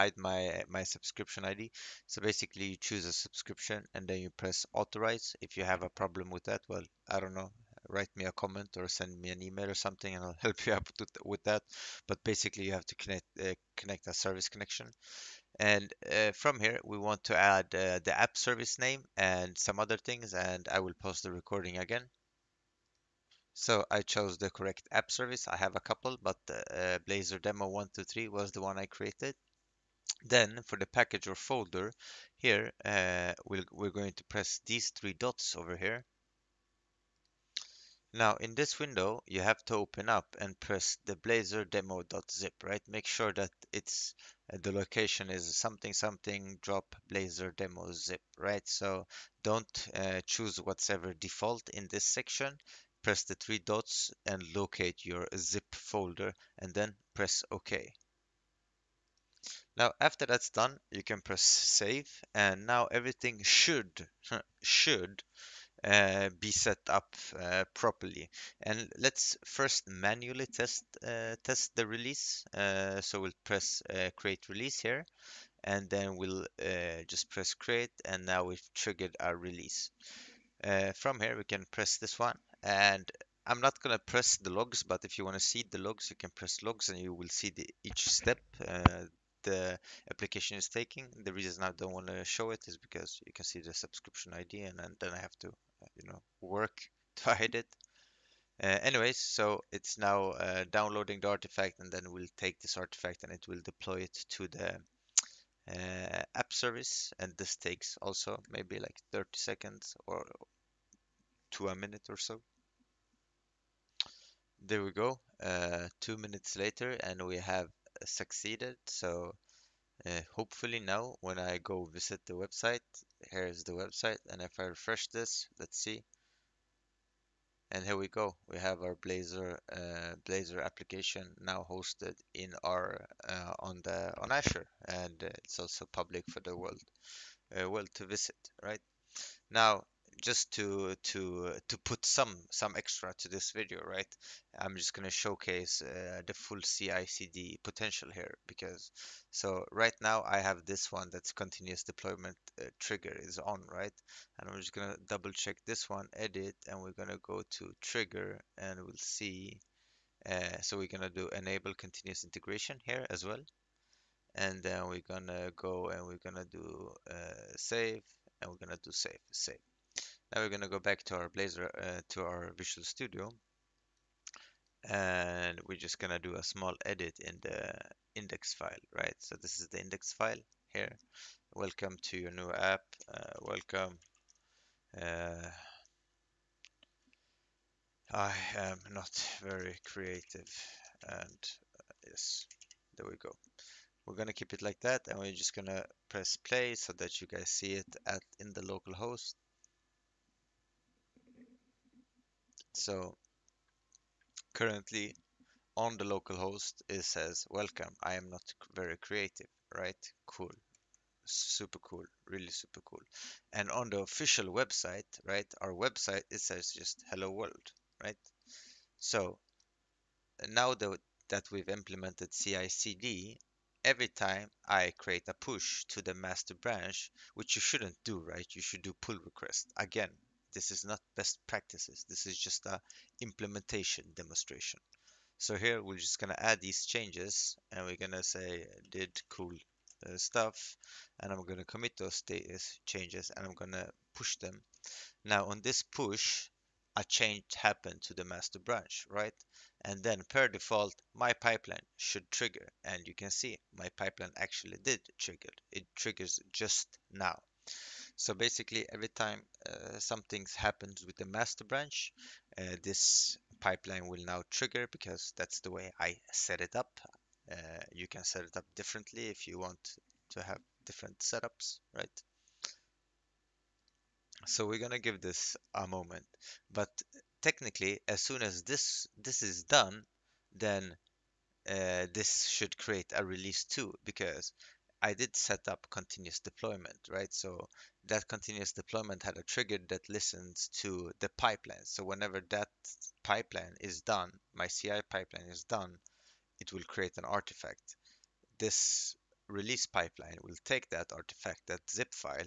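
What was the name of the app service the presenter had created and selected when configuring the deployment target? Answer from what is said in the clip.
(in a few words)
Blazor Demo 123.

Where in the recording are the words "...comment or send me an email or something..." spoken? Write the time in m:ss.
0:08.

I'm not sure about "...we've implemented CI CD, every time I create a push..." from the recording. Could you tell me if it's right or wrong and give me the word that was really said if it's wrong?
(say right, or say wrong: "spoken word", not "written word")
right.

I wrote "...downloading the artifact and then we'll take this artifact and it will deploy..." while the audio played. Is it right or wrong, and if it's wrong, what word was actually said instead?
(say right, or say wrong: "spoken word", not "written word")
right.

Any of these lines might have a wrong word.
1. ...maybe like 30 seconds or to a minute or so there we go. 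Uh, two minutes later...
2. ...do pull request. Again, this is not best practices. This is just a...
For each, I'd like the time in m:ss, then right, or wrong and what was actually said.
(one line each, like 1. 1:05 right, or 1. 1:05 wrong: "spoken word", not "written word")
1. 1:48 right
2. 3:48 right.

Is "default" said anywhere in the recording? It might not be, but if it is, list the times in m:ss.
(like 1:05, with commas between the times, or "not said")
0:51, 4:10.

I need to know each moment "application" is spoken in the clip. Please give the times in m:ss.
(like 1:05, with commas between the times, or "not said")
1:30, 2:10.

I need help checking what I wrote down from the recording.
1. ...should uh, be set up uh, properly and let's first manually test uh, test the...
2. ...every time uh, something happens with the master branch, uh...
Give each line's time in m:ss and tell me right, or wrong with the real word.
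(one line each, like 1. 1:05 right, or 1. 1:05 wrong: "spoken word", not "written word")
1. 1:04 right
2. 4:18 right.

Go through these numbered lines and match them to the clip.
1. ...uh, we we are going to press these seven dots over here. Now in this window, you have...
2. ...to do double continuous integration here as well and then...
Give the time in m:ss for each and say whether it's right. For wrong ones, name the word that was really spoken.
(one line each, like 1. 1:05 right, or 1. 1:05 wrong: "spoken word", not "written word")
1. 0:32 wrong: "three", not "seven"
2. 2:41 wrong: "enable", not "double".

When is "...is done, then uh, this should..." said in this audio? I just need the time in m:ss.
4:39.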